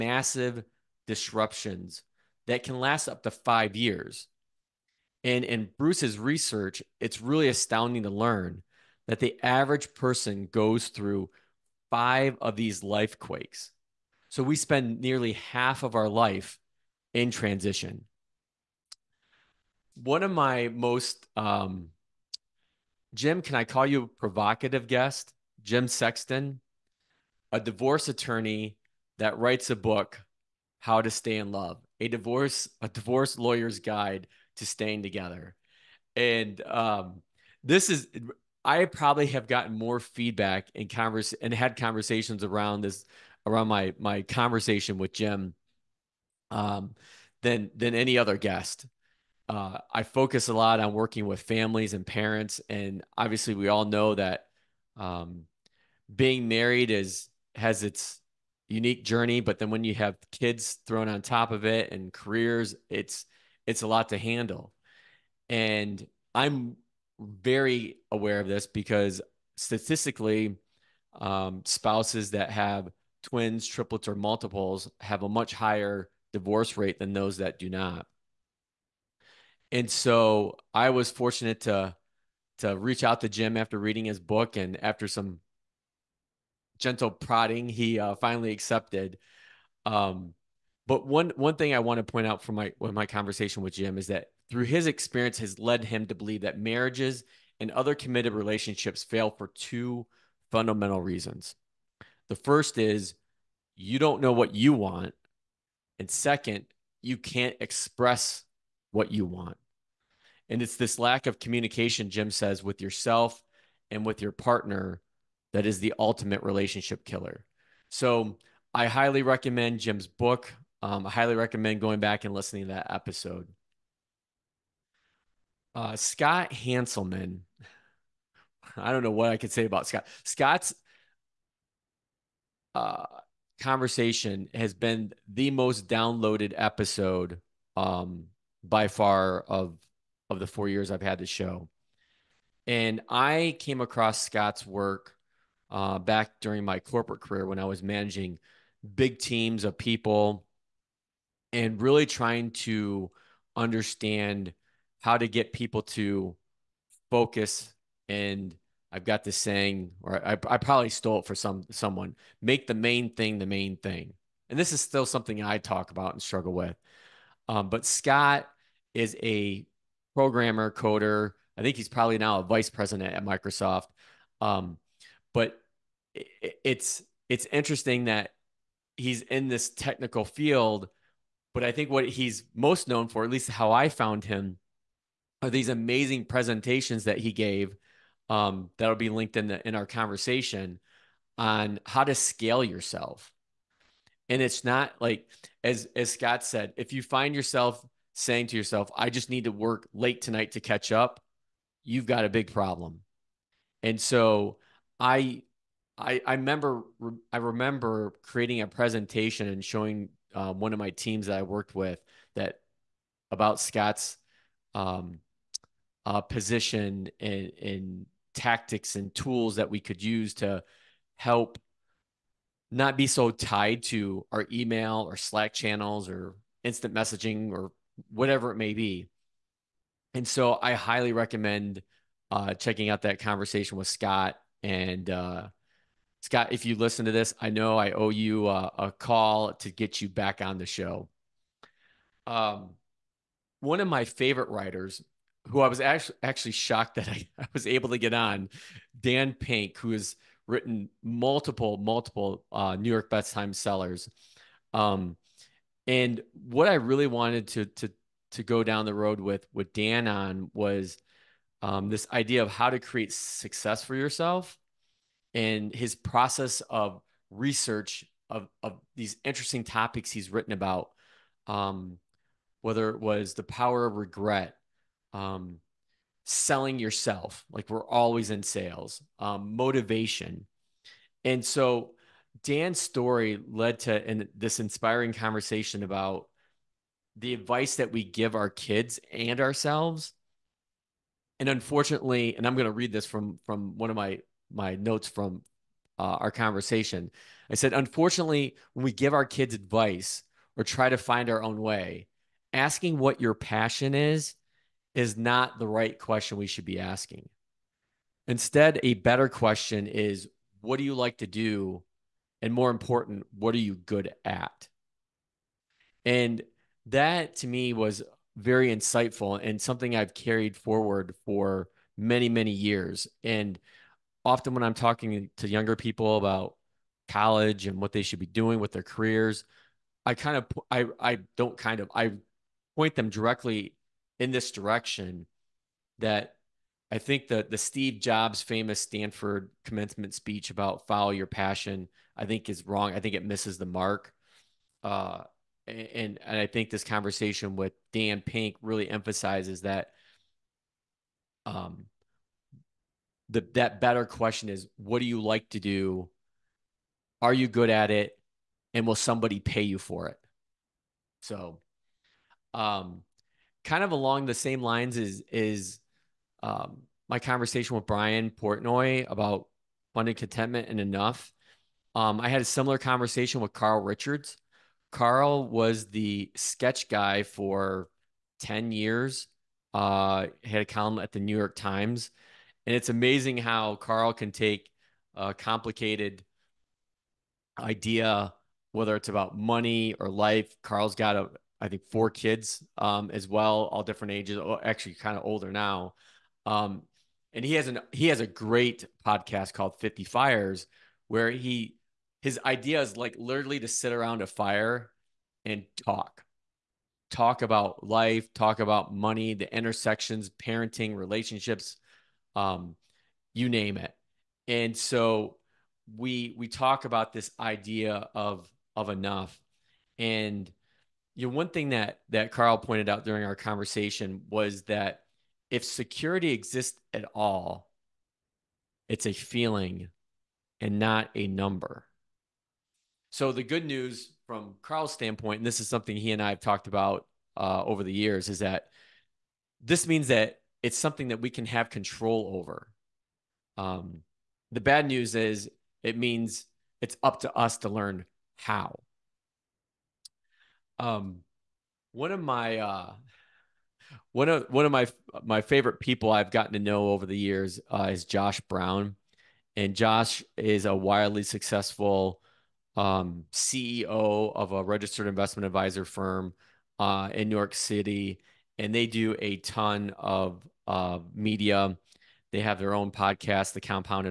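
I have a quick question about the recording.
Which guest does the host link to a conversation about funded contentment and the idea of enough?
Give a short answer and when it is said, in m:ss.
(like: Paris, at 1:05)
Brian Portnoy, at 6:07.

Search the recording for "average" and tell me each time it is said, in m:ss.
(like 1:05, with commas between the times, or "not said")
0:09.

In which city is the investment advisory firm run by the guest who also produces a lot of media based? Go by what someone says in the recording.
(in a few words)
New York City.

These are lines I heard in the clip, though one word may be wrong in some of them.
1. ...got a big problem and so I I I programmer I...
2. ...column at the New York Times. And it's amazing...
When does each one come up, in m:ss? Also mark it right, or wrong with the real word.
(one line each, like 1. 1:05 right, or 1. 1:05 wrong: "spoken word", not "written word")
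1. 3:22 wrong: "remember", not "programmer"
2. 6:20 right.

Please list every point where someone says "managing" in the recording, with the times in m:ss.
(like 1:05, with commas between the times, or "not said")
2:27.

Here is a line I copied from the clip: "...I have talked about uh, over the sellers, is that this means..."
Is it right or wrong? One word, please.
wrong.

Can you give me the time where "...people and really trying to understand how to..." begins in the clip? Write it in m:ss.
2:29.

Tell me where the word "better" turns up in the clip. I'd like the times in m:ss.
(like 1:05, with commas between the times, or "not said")
5:08, 5:53.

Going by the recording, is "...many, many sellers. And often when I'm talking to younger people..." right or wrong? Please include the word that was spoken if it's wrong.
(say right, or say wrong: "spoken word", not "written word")
wrong: "years", not "sellers".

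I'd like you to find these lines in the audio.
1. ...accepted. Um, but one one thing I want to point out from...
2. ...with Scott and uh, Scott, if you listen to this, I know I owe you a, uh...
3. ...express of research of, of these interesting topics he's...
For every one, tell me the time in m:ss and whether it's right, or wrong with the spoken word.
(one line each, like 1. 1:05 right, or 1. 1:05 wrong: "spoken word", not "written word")
1. 1:28 right
2. 3:53 right
3. 4:25 wrong: "process", not "express".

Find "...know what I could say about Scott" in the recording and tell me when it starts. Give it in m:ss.
2:09.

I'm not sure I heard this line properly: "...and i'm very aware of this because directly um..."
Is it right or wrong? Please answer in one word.
wrong.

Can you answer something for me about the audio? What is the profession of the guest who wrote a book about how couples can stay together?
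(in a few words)
divorce attorney.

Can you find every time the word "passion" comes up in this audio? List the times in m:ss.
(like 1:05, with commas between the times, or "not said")
5:03, 5:41.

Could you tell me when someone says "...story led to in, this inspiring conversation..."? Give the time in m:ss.
4:42.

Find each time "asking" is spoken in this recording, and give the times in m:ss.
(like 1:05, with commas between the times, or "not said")
5:02, 5:06.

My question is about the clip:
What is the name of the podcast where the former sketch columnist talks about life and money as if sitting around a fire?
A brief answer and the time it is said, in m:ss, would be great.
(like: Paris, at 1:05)
50 Fires, at 6:39.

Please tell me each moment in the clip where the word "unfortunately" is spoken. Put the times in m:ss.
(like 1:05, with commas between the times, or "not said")
4:51, 4:57.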